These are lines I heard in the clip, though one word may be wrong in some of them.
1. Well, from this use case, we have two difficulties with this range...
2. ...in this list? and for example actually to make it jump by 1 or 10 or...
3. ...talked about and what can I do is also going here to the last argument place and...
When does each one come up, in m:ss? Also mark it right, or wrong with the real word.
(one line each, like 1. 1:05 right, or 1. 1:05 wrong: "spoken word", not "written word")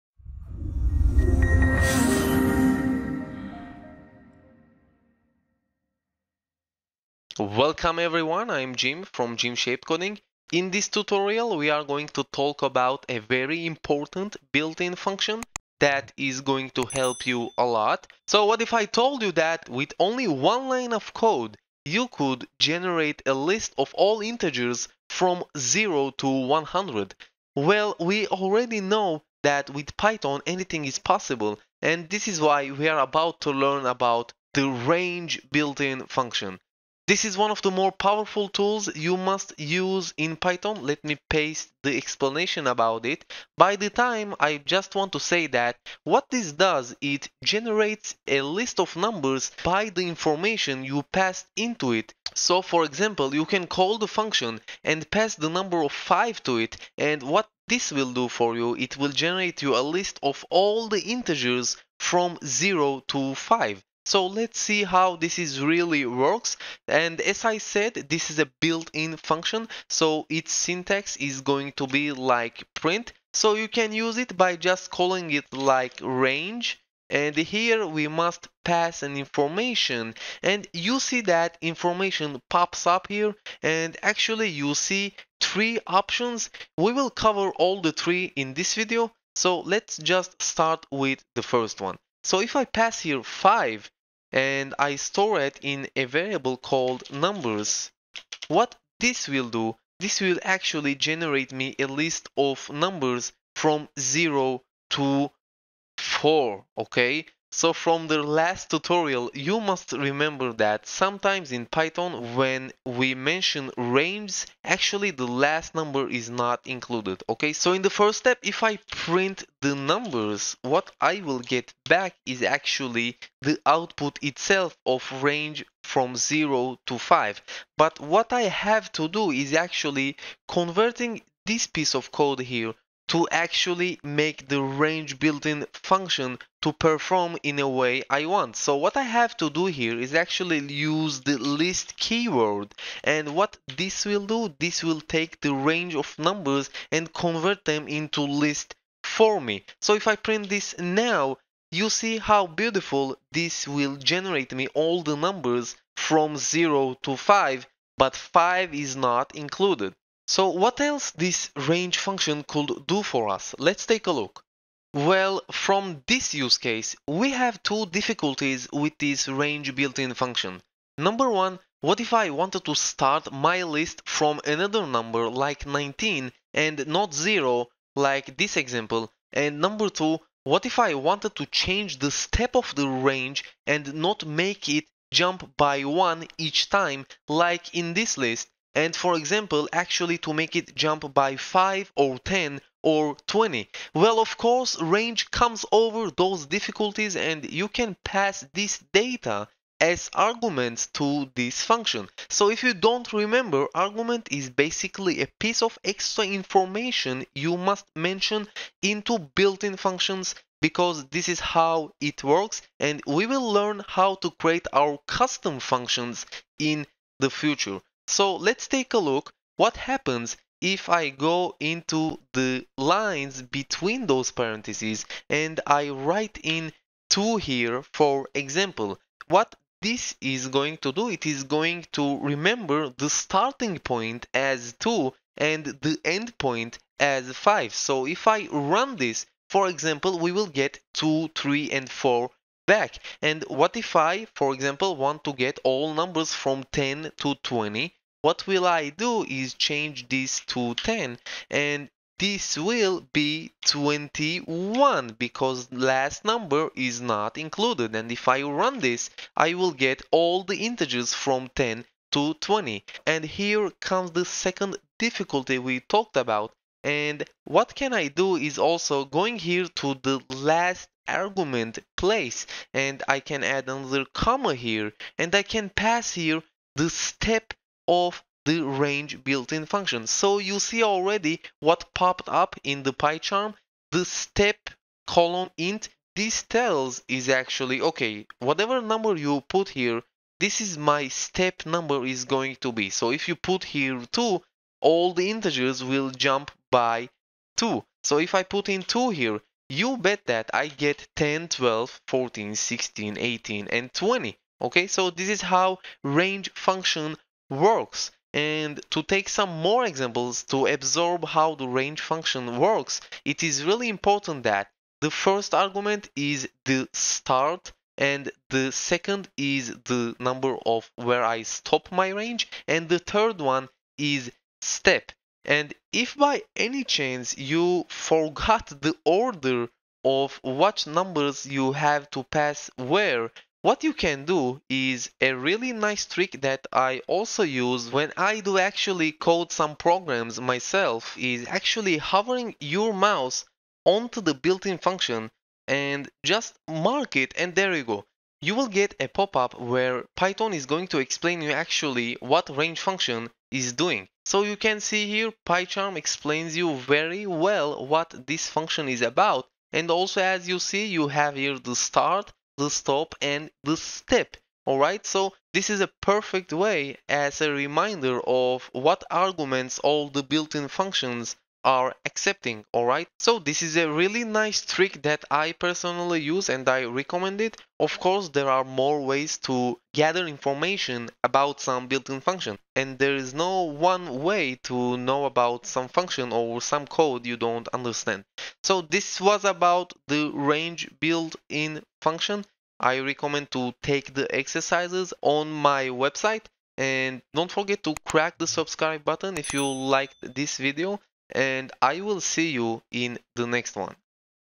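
1. 2:44 right
2. 3:07 wrong: "5", not "1"
3. 4:25 right.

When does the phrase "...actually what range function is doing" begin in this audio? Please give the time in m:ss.
5:51.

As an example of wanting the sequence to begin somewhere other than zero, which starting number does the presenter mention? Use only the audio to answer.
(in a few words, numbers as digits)
19.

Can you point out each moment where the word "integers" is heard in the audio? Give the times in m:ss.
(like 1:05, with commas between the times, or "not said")
0:24, 1:01, 4:20, 4:55.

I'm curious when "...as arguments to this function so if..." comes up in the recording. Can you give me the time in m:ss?
3:19.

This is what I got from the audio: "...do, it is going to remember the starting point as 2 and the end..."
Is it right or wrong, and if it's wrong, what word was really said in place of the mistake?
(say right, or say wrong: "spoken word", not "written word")
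right.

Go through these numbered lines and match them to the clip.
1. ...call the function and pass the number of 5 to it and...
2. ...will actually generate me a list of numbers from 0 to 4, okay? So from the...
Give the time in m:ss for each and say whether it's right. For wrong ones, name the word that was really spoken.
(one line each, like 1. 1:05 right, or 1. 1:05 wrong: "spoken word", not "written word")
1. 0:53 right
2. 1:40 right.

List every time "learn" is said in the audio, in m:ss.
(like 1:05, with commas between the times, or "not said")
0:33, 3:33.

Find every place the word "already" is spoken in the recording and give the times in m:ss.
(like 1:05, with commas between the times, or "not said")
0:28, 4:40.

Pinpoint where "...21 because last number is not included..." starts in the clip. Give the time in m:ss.
4:13.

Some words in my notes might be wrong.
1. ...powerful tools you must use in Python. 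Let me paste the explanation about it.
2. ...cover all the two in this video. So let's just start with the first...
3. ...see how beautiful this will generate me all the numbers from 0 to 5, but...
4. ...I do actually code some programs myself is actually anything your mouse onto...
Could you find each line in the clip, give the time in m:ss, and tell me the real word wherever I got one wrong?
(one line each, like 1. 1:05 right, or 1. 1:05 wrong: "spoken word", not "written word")
1. 0:37 right
2. 1:27 wrong: "three", not "two"
3. 2:31 right
4. 5:38 wrong: "hovering", not "anything".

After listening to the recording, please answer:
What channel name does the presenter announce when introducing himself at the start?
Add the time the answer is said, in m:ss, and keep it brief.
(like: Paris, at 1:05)
Jim Shaped Coding, at 0:09.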